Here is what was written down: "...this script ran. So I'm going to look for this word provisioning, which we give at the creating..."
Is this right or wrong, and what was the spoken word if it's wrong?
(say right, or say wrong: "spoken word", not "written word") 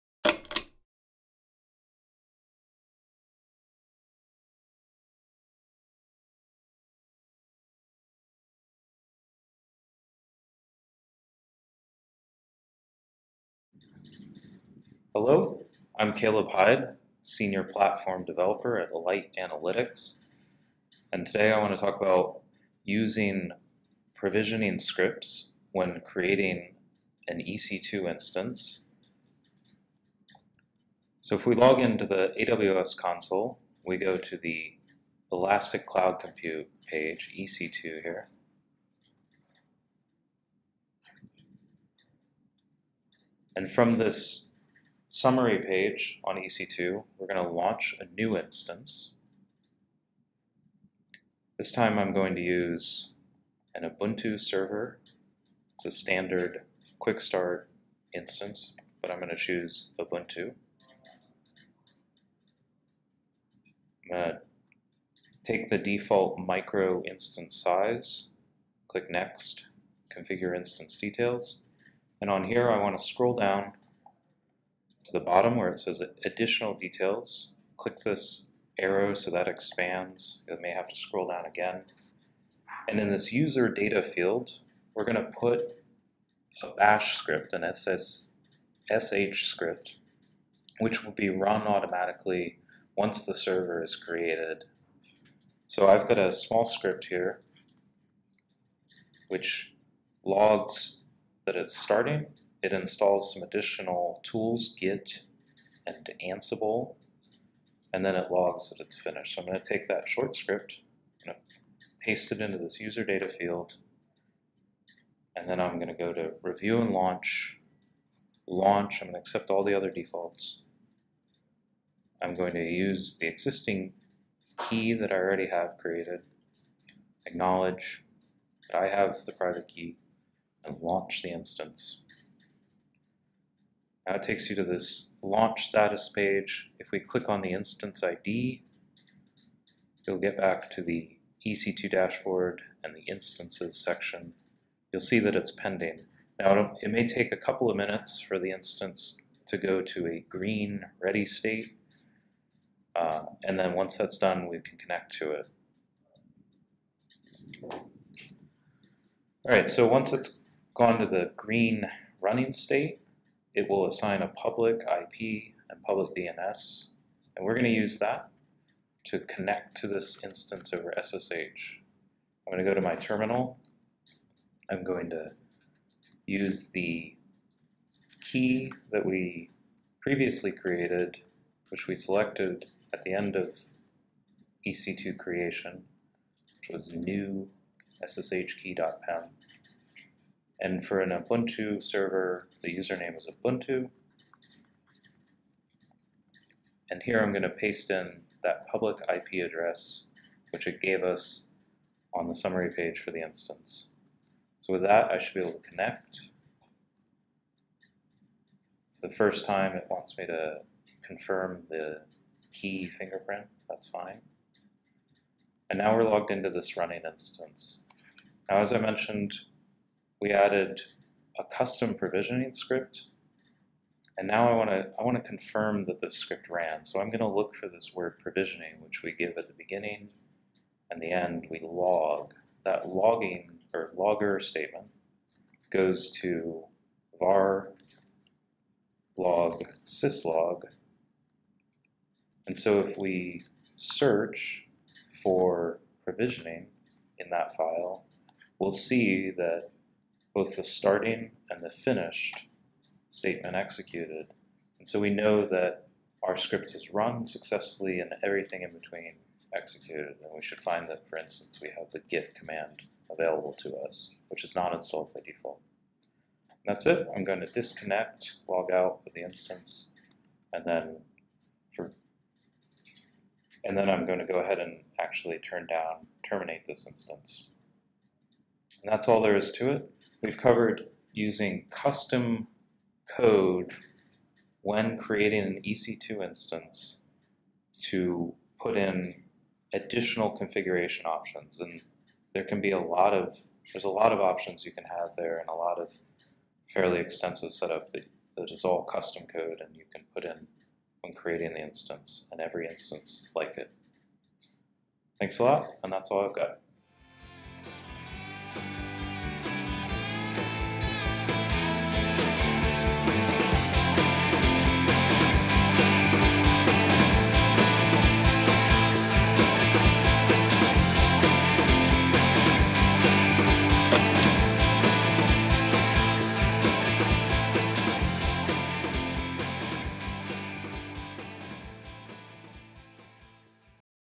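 wrong: "beginning", not "creating".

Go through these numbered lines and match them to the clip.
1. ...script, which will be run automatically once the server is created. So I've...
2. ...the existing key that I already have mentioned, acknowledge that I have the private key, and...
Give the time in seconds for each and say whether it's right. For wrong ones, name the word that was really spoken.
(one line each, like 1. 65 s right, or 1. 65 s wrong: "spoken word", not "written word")
1. 89 s right
2. 123 s wrong: "created", not "mentioned".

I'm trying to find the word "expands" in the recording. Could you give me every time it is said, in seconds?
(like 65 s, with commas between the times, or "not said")
79 s.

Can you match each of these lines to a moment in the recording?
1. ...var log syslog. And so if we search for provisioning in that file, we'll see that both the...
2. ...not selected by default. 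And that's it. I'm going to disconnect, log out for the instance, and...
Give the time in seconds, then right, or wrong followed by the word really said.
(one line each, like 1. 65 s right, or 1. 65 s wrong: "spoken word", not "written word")
1. 237 s right
2. 264 s wrong: "installed", not "selected".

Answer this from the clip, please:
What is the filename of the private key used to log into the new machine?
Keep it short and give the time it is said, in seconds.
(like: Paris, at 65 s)
new ssh key.pem, at 186 s.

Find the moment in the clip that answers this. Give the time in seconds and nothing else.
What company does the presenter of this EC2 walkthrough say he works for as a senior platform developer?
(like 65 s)
18 s.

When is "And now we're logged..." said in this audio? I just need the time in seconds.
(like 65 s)
215 s.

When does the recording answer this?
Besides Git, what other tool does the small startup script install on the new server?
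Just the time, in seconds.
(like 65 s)
106 s.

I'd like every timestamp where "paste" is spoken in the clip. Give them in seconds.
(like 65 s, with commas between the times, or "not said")
112 s, 197 s.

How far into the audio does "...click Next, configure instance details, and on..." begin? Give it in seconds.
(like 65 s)
68 s.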